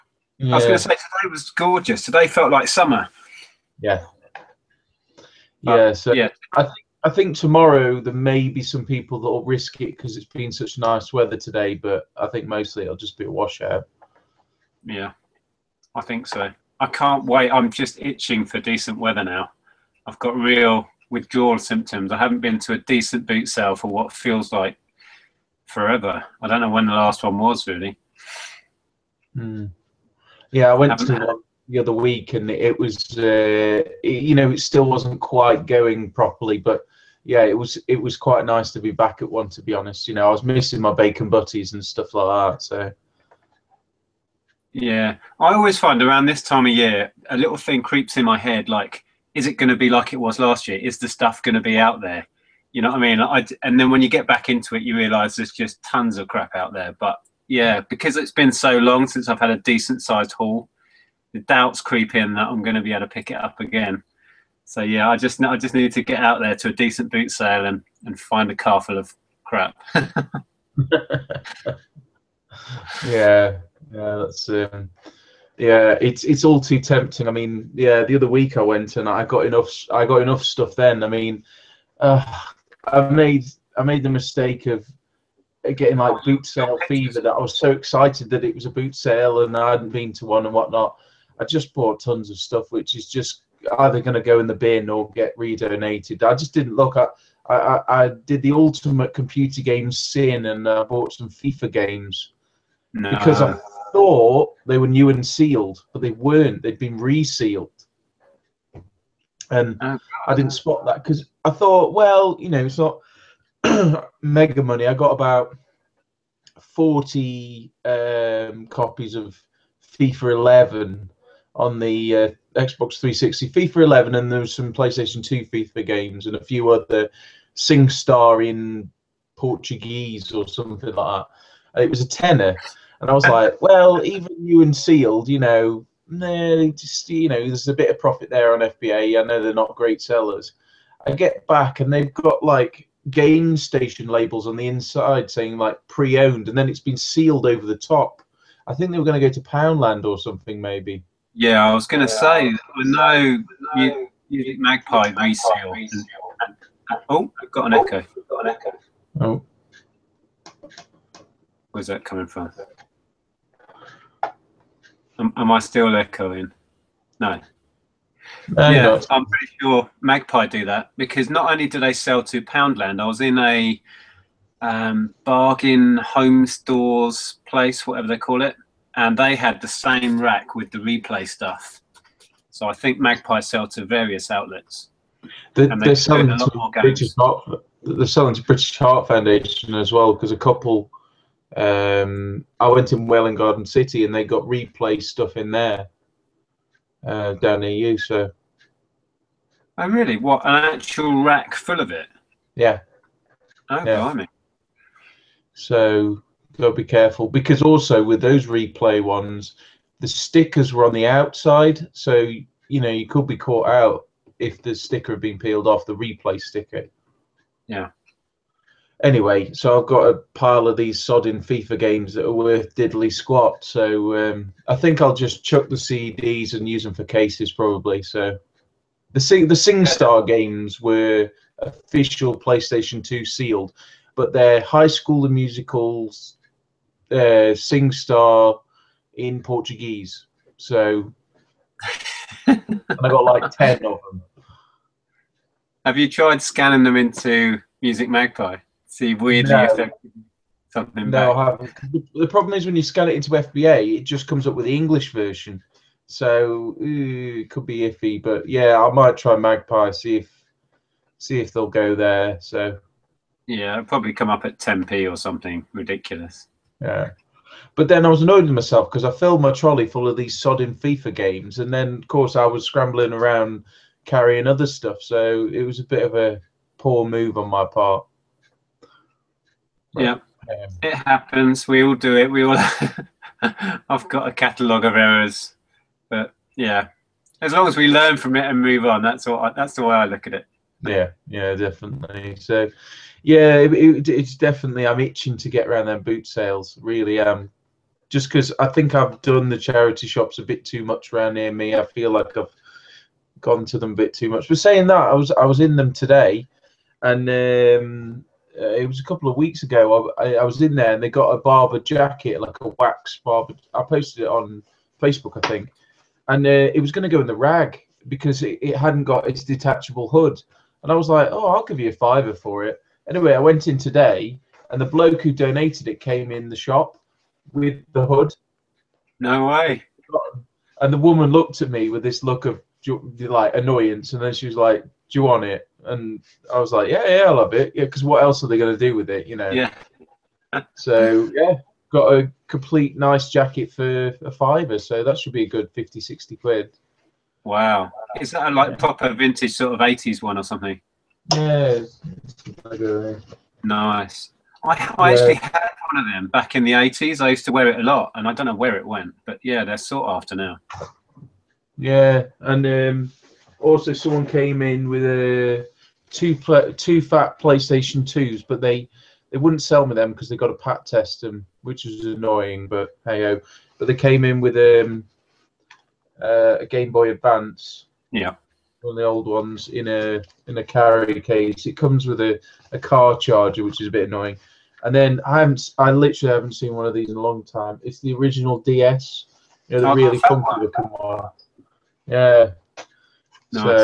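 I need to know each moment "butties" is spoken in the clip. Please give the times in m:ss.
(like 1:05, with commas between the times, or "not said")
0:41.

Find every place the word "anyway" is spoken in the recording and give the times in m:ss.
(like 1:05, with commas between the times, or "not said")
3:39, 5:23.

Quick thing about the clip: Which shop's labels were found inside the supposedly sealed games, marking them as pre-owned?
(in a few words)
Gamestation.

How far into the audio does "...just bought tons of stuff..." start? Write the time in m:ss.
1:31.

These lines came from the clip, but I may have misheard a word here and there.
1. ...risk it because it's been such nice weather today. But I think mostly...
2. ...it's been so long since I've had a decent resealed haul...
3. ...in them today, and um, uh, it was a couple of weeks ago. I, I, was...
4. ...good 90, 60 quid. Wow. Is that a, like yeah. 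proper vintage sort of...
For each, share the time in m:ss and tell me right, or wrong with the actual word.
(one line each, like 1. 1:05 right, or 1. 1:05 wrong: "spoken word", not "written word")
1. 0:09 right
2. 0:58 wrong: "sized", not "resealed"
3. 5:05 right
4. 5:45 wrong: "50", not "90".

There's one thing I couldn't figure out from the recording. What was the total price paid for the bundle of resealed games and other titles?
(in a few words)
A tenner.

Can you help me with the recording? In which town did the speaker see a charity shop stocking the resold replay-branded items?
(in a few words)
Welwyn Garden City.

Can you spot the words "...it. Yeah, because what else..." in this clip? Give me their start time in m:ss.
5:37.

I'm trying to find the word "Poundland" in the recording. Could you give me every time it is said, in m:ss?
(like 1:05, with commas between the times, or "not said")
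2:29, 2:52.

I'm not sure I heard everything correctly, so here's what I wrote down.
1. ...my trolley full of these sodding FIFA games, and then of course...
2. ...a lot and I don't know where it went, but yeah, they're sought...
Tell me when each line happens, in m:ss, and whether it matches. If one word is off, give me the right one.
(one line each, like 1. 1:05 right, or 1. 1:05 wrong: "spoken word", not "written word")
1. 4:29 right
2. 5:57 right.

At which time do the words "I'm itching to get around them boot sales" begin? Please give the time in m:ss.
4:54.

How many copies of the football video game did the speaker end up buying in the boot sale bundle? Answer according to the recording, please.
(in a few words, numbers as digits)
40.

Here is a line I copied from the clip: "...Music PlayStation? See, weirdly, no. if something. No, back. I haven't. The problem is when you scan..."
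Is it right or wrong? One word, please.
wrong.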